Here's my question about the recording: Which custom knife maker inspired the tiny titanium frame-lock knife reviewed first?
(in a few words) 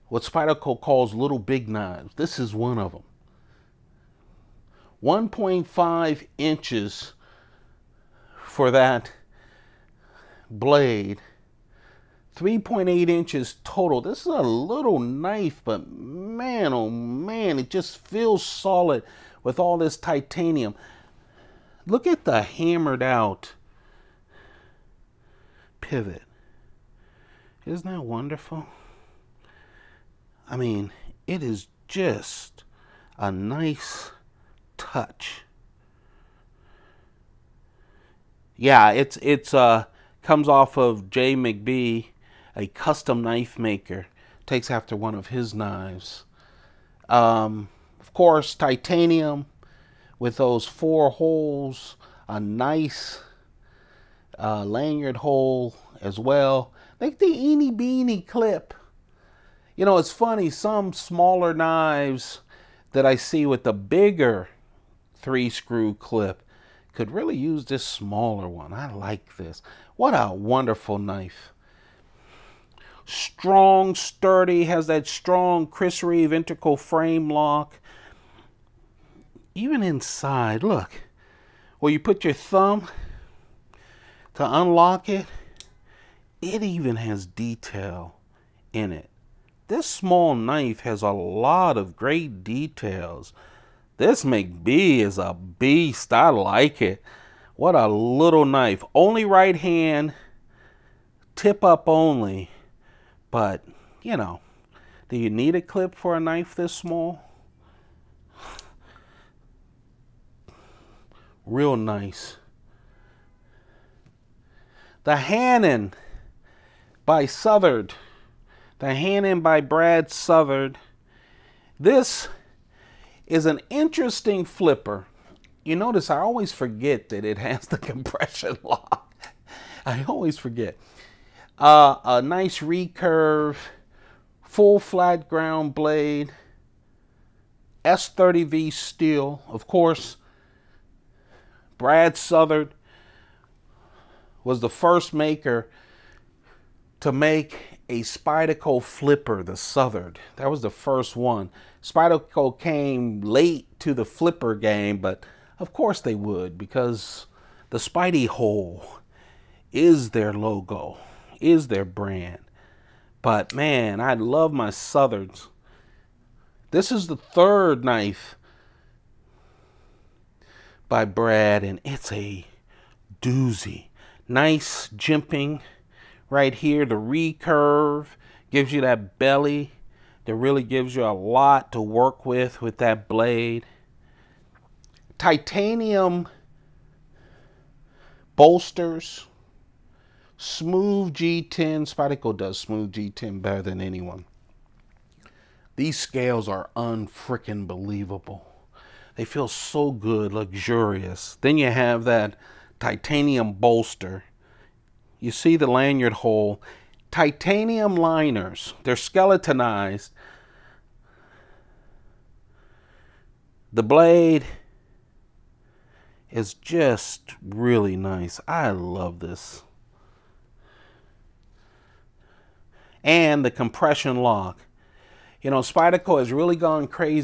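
J. McBee.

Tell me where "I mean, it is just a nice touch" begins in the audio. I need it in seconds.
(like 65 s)
30 s.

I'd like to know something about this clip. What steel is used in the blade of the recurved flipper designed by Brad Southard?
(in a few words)
S30V.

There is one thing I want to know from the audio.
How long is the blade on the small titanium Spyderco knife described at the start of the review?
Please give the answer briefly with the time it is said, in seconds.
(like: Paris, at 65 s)
1.5 inches, at 5 s.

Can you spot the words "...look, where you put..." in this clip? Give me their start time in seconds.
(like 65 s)
80 s.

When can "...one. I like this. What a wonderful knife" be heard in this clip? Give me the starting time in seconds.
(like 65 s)
68 s.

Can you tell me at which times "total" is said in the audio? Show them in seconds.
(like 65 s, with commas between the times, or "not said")
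13 s.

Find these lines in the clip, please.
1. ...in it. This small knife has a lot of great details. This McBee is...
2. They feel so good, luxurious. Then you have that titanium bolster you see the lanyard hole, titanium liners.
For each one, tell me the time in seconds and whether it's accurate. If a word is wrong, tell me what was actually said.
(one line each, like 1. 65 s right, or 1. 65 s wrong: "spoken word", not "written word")
1. 88 s right
2. 199 s right.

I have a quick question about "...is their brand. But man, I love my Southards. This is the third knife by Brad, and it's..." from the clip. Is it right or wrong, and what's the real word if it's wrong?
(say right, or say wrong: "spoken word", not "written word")
right.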